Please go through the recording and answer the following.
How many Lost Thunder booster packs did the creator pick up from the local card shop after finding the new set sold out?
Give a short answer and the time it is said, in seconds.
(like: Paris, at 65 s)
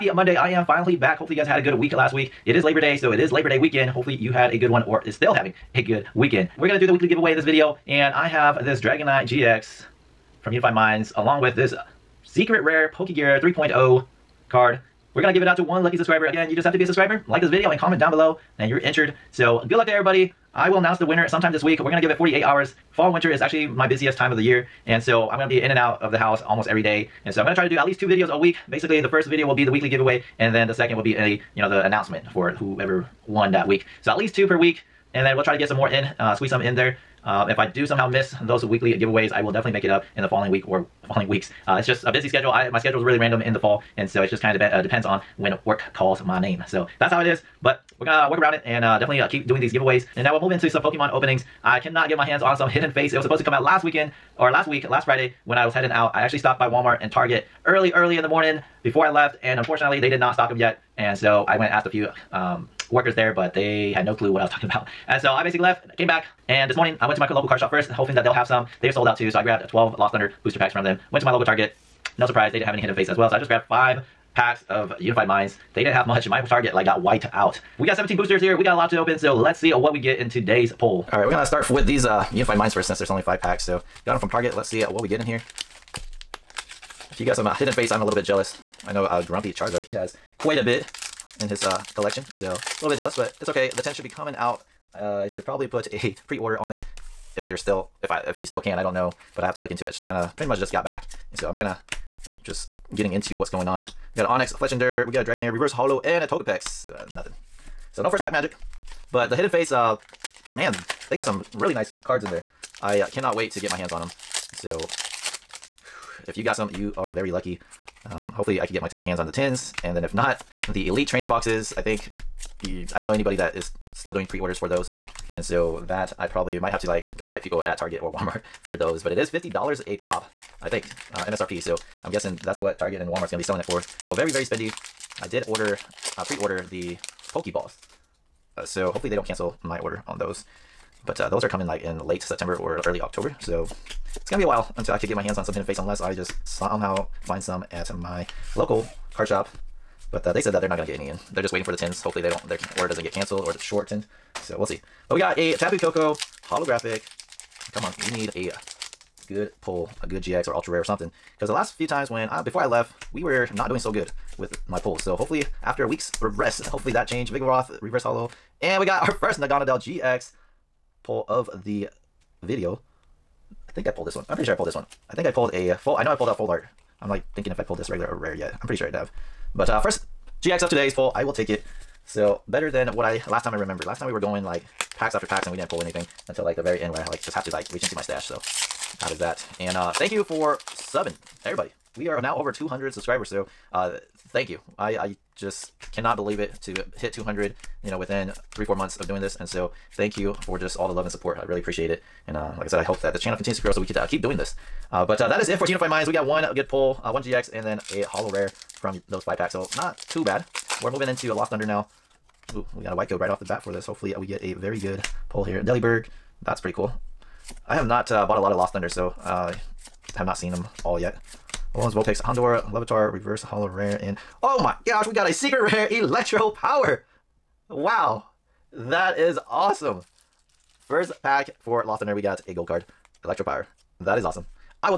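12, at 69 s.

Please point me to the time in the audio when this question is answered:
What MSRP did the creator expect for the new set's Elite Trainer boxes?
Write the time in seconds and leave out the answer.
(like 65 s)
129 s.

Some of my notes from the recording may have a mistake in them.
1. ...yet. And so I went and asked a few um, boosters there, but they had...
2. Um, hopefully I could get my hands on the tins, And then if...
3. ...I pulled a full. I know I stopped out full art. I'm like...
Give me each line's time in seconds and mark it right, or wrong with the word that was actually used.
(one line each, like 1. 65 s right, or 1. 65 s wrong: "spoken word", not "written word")
1. 60 s wrong: "workers", not "boosters"
2. 118 s right
3. 175 s wrong: "pulled", not "stopped".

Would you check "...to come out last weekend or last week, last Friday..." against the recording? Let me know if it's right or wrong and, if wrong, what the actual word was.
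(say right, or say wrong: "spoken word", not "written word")
right.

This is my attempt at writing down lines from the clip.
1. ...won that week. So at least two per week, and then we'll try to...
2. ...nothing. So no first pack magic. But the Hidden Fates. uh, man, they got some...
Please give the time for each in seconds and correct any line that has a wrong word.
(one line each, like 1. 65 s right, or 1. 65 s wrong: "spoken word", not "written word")
1. 33 s right
2. 107 s right.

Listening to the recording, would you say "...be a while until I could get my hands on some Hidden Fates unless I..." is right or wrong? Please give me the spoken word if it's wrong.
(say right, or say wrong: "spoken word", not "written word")
right.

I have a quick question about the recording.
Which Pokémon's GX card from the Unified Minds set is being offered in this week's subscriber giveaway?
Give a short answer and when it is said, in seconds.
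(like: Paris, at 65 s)
Dragonite, at 8 s.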